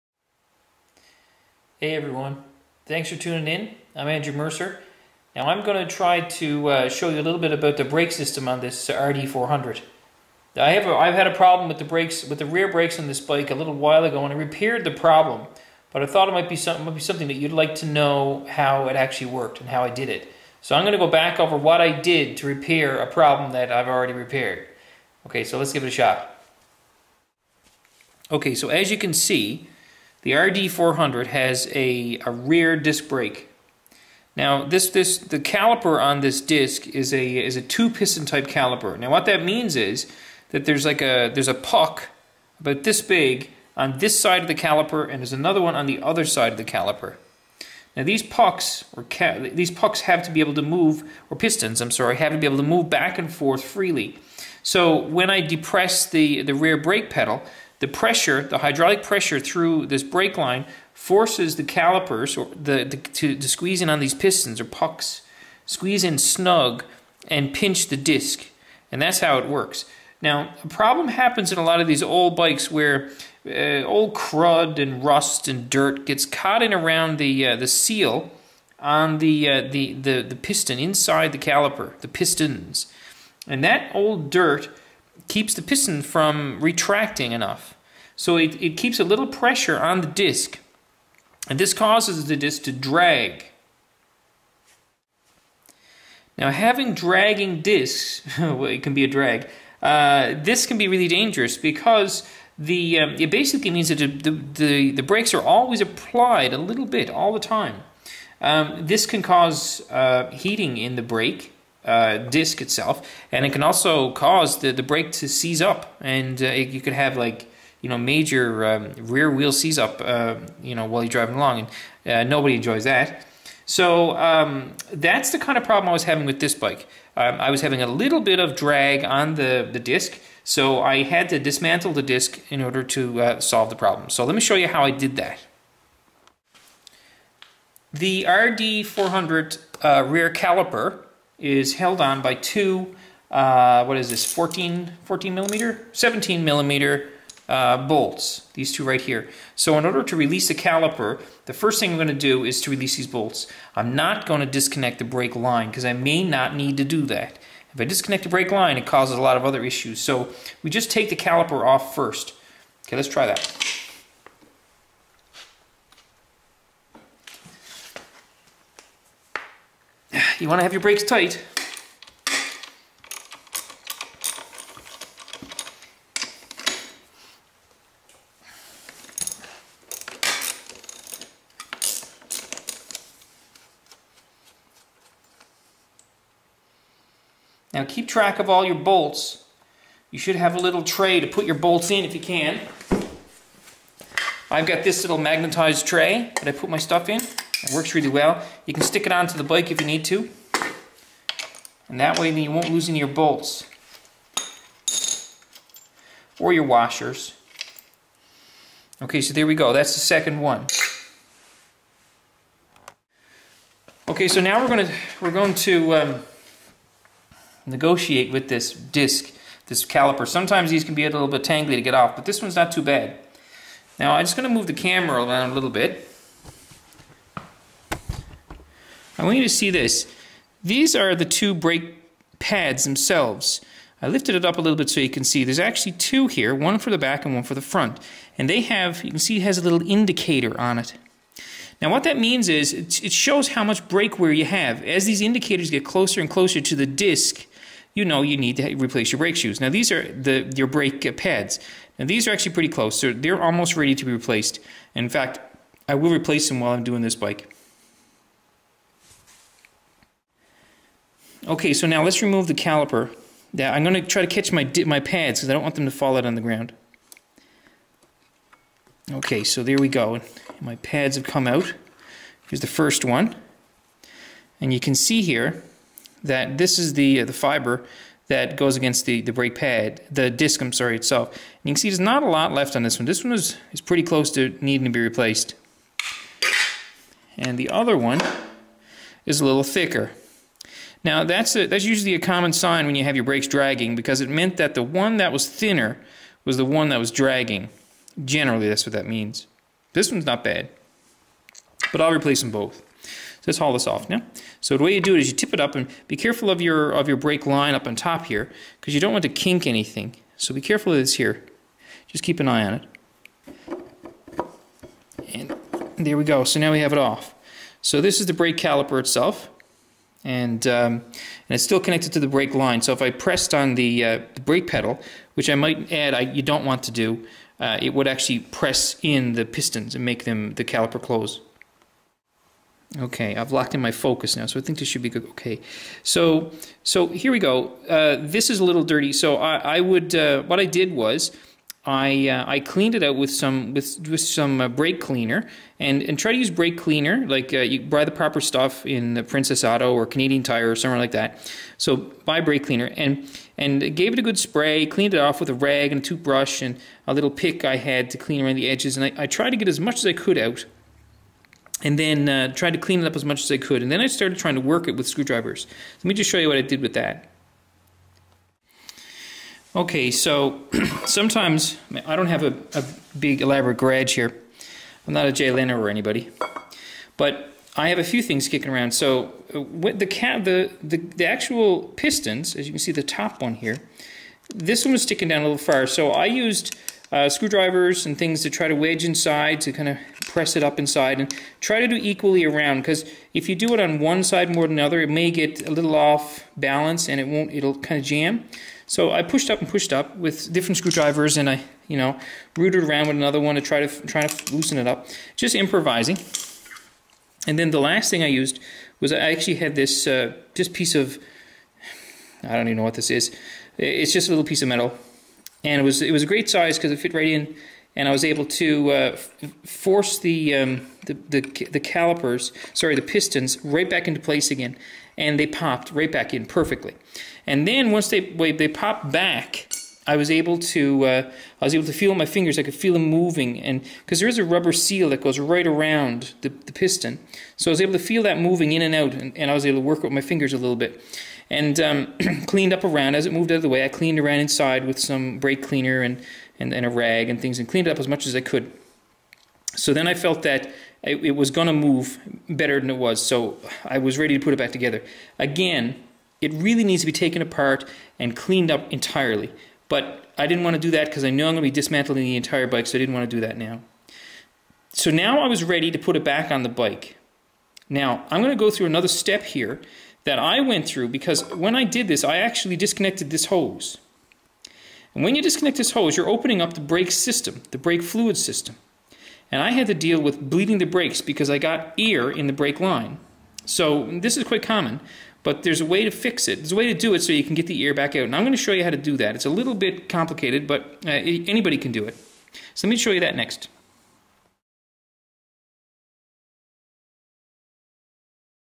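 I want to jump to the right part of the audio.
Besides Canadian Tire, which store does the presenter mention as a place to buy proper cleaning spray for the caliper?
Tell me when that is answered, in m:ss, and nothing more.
5:49.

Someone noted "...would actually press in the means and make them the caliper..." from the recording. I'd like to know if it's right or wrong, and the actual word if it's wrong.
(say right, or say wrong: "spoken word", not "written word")
wrong: "pistons", not "means".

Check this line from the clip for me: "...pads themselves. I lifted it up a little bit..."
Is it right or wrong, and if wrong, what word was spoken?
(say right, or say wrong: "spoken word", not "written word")
right.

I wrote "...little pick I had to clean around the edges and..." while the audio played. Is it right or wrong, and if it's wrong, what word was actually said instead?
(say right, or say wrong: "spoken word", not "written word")
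right.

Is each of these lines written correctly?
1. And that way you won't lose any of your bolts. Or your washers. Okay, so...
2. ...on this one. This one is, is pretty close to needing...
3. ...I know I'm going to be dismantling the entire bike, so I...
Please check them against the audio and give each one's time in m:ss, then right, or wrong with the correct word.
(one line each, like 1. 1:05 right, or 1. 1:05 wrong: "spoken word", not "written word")
1. 3:21 right
2. 4:42 right
3. 7:41 right.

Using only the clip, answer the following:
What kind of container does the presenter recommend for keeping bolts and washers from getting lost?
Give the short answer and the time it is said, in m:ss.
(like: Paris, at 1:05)
magnetized tray, at 3:15.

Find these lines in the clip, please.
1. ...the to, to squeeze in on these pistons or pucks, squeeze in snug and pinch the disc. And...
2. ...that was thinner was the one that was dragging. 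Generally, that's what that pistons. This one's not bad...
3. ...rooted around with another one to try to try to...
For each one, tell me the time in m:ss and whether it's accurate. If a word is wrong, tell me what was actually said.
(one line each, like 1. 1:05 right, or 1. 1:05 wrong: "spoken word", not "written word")
1. 1:02 right
2. 4:55 wrong: "means", not "pistons"
3. 6:42 right.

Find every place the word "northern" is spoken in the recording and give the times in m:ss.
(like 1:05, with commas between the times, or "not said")
not said.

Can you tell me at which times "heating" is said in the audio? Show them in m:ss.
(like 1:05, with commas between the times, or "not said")
1:50.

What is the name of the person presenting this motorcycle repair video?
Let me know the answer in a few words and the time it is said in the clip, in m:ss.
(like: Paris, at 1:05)
Andrew Mercer, at 0:04.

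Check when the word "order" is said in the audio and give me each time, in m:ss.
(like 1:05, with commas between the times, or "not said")
2:12, 2:29.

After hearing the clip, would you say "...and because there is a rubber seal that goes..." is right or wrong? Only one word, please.
right.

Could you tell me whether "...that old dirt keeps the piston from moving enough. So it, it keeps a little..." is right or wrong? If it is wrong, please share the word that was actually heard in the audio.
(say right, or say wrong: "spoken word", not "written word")
wrong: "retracting", not "moving".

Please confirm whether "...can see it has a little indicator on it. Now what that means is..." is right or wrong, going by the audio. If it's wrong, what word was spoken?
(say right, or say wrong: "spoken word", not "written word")
right.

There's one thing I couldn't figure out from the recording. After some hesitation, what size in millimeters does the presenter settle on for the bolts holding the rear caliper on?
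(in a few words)
17 millimeter.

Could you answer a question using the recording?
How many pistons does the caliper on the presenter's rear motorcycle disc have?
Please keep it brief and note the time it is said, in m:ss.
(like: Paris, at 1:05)
two piston, at 0:37.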